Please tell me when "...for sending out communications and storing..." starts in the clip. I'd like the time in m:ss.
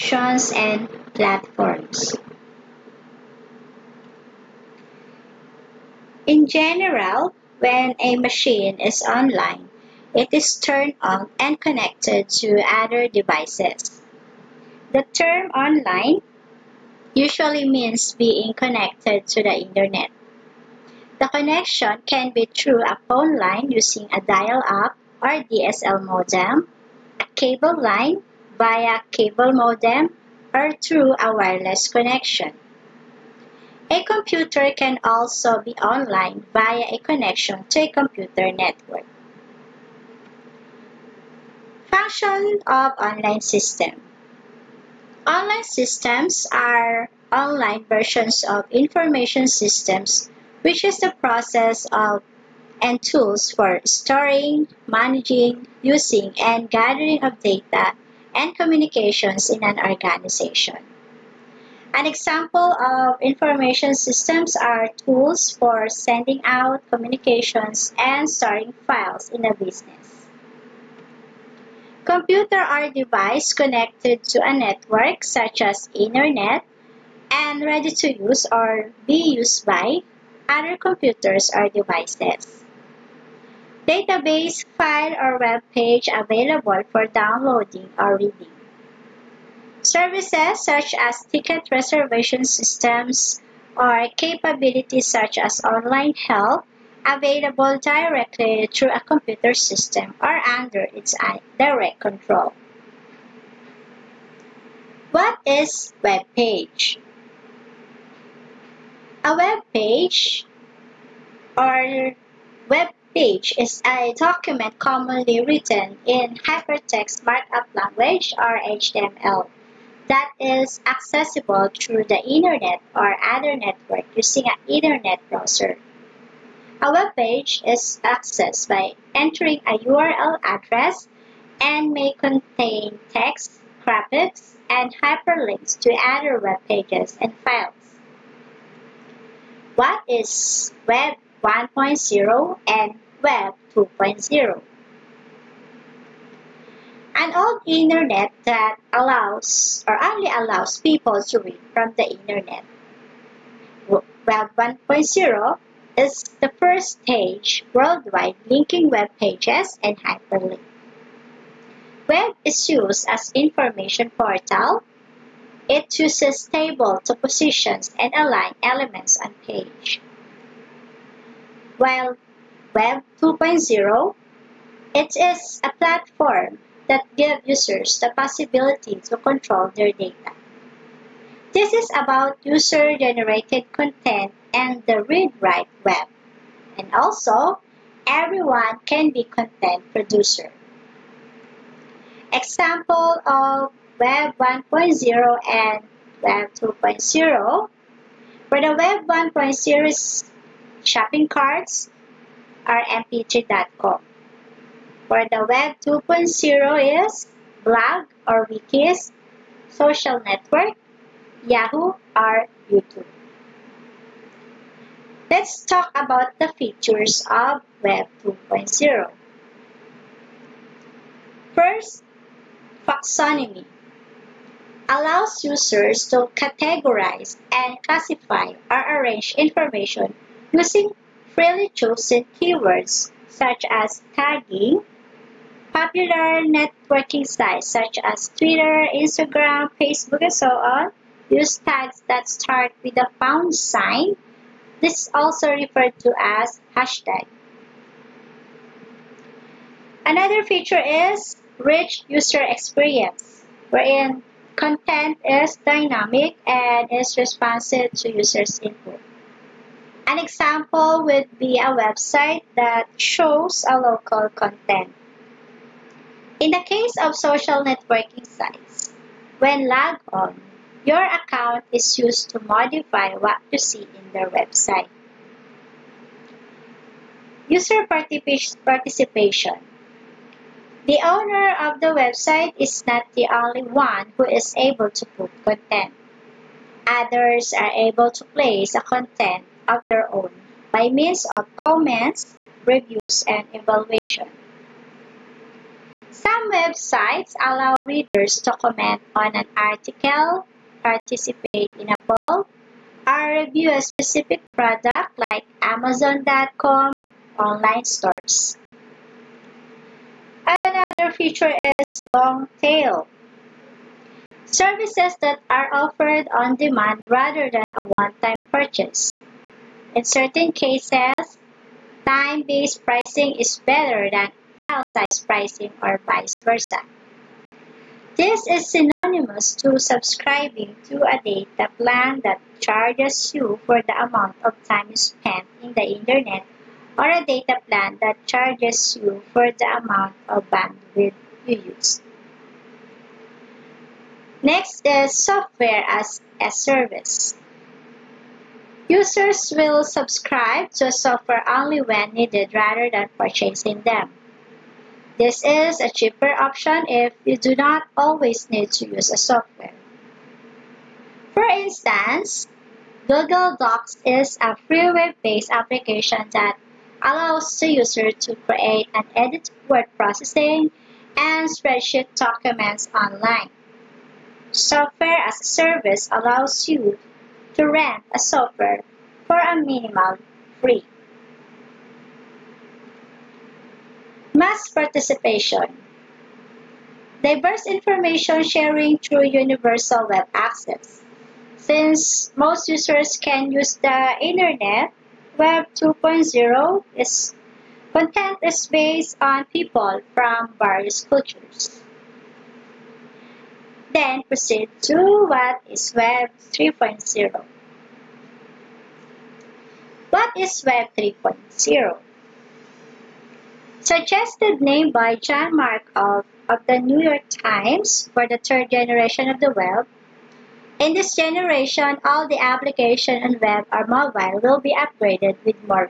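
1:05.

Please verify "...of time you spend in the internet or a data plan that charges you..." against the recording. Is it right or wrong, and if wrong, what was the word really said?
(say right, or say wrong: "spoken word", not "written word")
right.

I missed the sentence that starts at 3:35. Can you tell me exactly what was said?
Let's talk about the features of Web 2.0.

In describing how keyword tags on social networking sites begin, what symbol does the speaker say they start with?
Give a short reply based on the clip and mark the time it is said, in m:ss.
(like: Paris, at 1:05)
pound sign, at 4:03.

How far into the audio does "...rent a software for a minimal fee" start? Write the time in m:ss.
6:17.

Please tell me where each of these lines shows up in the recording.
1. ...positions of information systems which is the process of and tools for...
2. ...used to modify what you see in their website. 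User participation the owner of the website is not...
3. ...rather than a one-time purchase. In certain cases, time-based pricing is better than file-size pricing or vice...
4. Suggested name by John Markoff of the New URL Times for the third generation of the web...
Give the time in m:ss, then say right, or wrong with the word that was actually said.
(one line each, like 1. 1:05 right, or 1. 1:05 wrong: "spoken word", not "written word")
1. 0:47 wrong: "versions", not "positions"
2. 4:31 right
3. 5:17 right
4. 6:53 wrong: "York", not "URL".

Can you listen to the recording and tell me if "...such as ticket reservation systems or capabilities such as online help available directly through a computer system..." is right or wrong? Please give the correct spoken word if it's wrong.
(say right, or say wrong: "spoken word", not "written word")
right.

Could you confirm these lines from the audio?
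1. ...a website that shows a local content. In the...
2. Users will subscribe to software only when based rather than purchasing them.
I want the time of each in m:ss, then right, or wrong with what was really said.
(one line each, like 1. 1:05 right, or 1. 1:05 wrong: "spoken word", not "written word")
1. 4:21 right
2. 5:48 wrong: "needed", not "based".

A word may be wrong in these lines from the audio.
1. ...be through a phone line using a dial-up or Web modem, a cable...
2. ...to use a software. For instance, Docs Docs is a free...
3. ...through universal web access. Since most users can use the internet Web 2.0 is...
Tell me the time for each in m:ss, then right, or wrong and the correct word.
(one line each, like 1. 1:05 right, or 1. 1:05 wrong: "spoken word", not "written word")
1. 0:22 wrong: "DSL", not "Web"
2. 5:58 wrong: "Google", not "Docs"
3. 6:28 right.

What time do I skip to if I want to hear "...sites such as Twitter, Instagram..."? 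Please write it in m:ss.
3:57.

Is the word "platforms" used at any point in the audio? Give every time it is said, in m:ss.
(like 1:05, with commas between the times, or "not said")
0:01, 2:55.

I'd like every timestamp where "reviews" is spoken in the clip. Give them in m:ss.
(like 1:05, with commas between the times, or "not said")
4:52, 5:03.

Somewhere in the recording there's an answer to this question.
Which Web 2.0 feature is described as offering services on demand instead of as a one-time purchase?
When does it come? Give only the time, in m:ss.
5:12.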